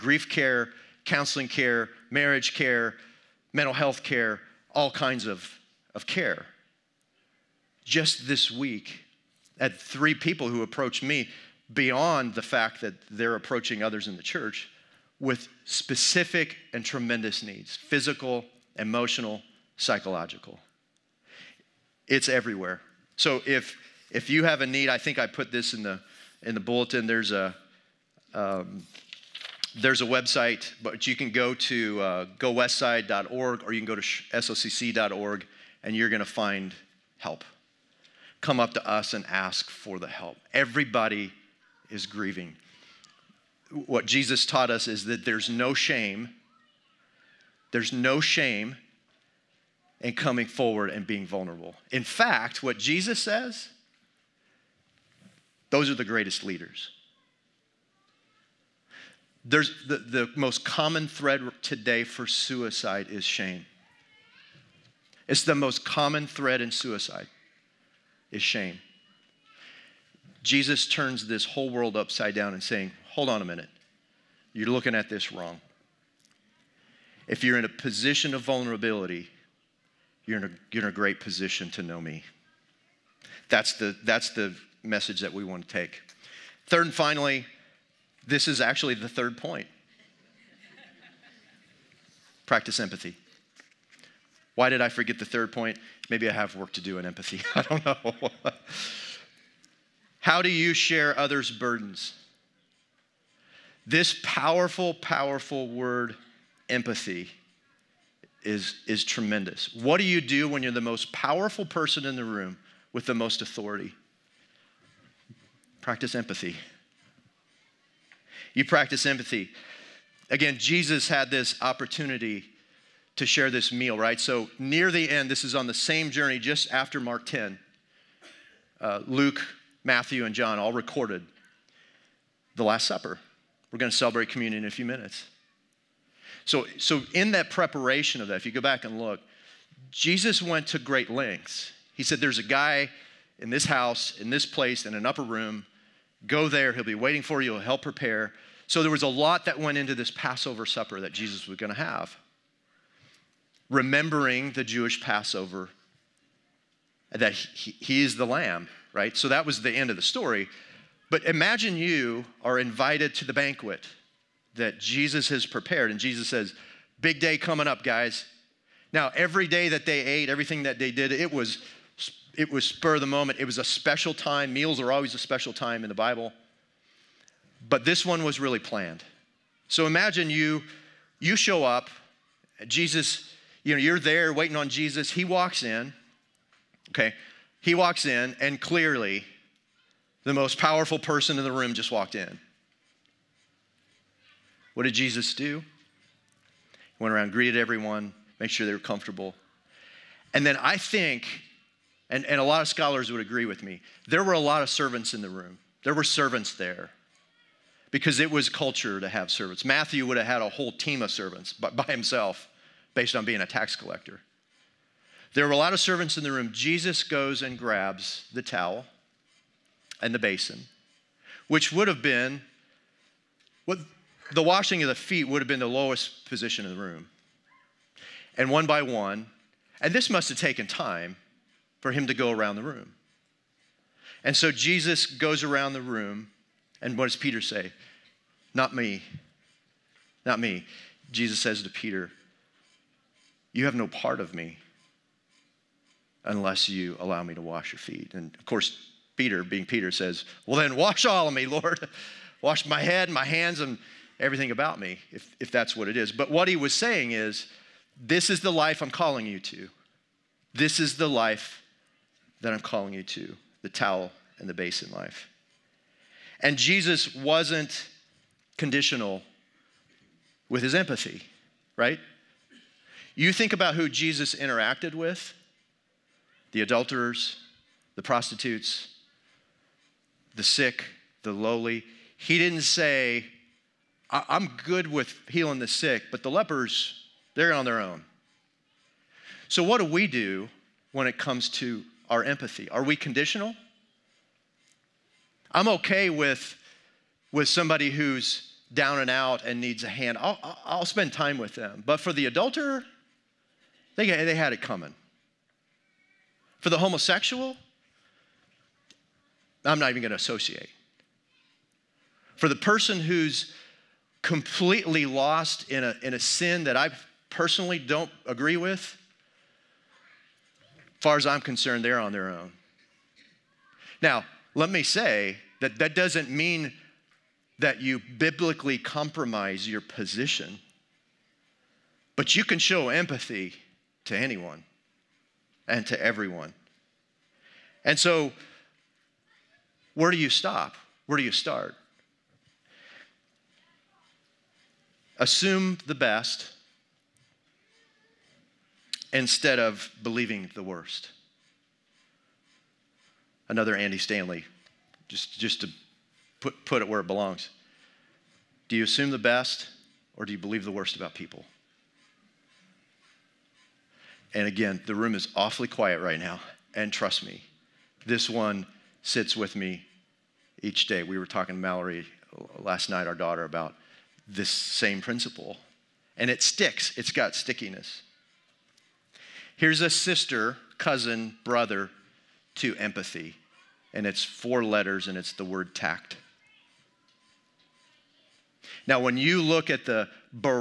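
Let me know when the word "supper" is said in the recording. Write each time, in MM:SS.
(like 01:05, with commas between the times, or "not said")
02:12, 02:30.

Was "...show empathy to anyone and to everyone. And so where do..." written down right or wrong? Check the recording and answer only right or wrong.
right.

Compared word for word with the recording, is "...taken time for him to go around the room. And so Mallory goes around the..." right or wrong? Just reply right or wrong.
wrong.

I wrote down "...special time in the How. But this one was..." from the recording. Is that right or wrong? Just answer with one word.
wrong.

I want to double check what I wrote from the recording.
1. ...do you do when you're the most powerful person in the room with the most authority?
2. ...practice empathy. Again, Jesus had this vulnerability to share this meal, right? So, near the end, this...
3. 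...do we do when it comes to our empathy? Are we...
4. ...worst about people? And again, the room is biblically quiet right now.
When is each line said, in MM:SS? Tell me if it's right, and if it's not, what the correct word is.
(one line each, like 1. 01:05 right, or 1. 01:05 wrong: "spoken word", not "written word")
1. 01:49 right
2. 01:58 wrong: "opportunity", not "vulnerability"
3. 04:49 right
4. 06:00 wrong: "awfully", not "biblically".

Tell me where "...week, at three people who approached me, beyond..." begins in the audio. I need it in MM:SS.
00:08.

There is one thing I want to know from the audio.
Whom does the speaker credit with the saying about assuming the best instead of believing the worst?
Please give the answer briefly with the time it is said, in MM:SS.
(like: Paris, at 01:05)
Andy Stanley, at 05:53.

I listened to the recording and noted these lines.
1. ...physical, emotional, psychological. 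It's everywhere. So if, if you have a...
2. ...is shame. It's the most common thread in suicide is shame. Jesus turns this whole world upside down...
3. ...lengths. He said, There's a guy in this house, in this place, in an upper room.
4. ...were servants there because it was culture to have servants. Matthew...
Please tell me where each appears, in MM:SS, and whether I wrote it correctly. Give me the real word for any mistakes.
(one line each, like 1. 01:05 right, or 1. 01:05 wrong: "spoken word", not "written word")
1. 00:17 right
2. 01:03 right
3. 02:21 right
4. 03:25 right.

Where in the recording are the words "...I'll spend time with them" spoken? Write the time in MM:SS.
05:00.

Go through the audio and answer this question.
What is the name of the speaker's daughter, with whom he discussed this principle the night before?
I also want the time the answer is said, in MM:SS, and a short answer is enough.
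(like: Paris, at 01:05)
Mallory, at 06:11.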